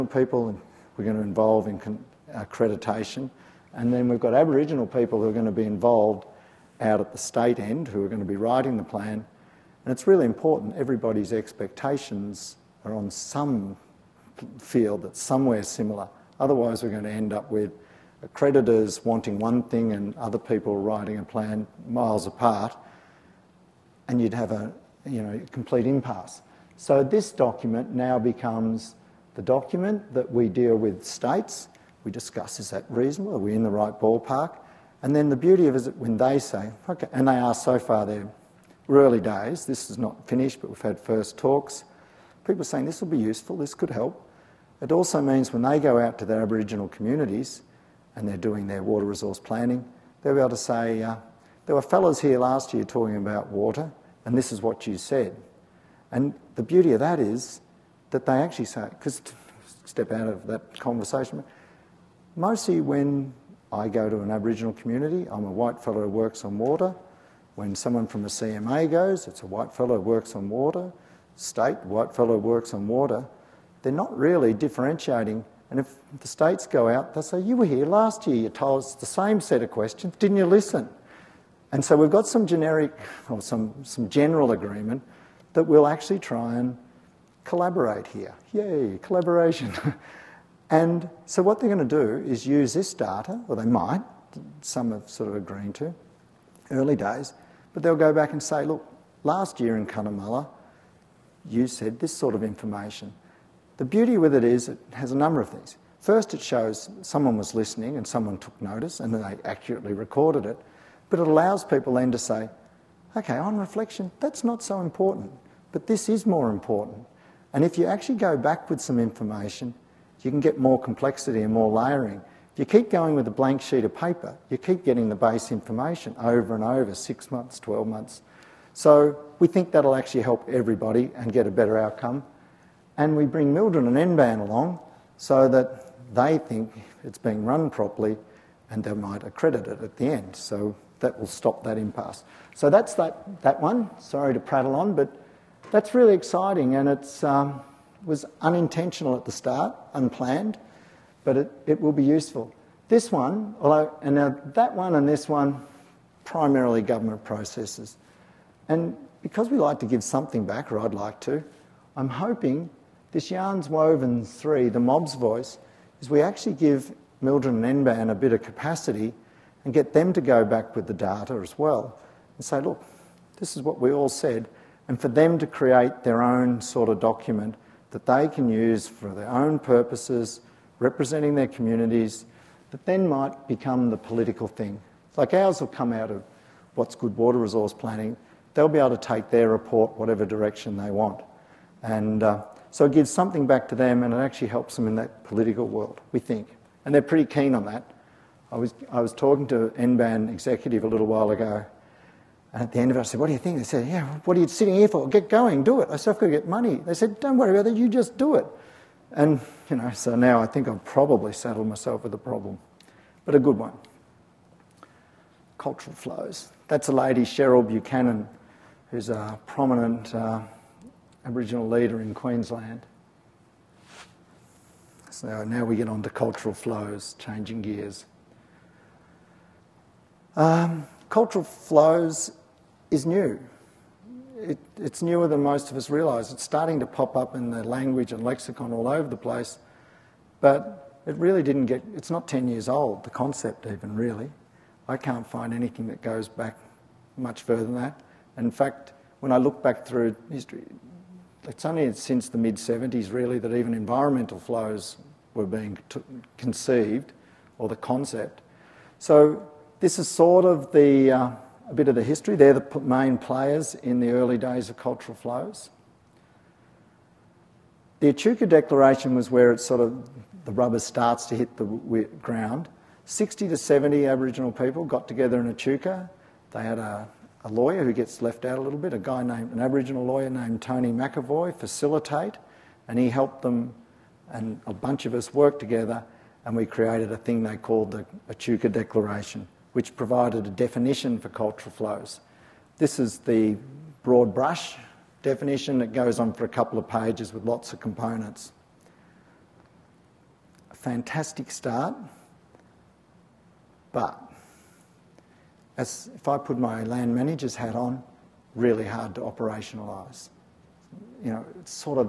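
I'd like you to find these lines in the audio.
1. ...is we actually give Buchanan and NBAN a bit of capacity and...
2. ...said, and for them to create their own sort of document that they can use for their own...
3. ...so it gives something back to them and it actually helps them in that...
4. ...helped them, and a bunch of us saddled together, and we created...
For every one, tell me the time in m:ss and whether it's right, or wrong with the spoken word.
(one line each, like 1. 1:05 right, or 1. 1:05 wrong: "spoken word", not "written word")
1. 2:46 wrong: "MLDRIN", not "Buchanan"
2. 2:54 right
3. 3:12 right
4. 4:43 wrong: "worked", not "saddled".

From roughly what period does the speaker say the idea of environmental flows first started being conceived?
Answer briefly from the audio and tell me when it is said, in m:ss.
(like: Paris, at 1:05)
mid-70s, at 4:12.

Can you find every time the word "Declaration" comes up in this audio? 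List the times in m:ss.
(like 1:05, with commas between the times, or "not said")
4:28, 4:48.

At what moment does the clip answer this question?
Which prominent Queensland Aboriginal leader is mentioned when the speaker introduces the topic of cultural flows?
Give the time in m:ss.
3:37.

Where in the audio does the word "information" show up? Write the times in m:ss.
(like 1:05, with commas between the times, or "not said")
1:42, 1:58, 2:05.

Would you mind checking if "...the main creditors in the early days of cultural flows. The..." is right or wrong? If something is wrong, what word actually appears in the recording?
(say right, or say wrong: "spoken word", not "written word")
wrong: "players", not "creditors".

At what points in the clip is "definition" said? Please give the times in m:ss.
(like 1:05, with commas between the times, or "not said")
4:50, 4:55.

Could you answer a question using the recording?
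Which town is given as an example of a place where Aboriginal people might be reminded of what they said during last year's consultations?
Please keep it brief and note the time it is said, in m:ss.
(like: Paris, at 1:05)
Cunnamulla, at 1:39.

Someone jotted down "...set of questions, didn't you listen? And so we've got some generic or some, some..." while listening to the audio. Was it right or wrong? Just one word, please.
right.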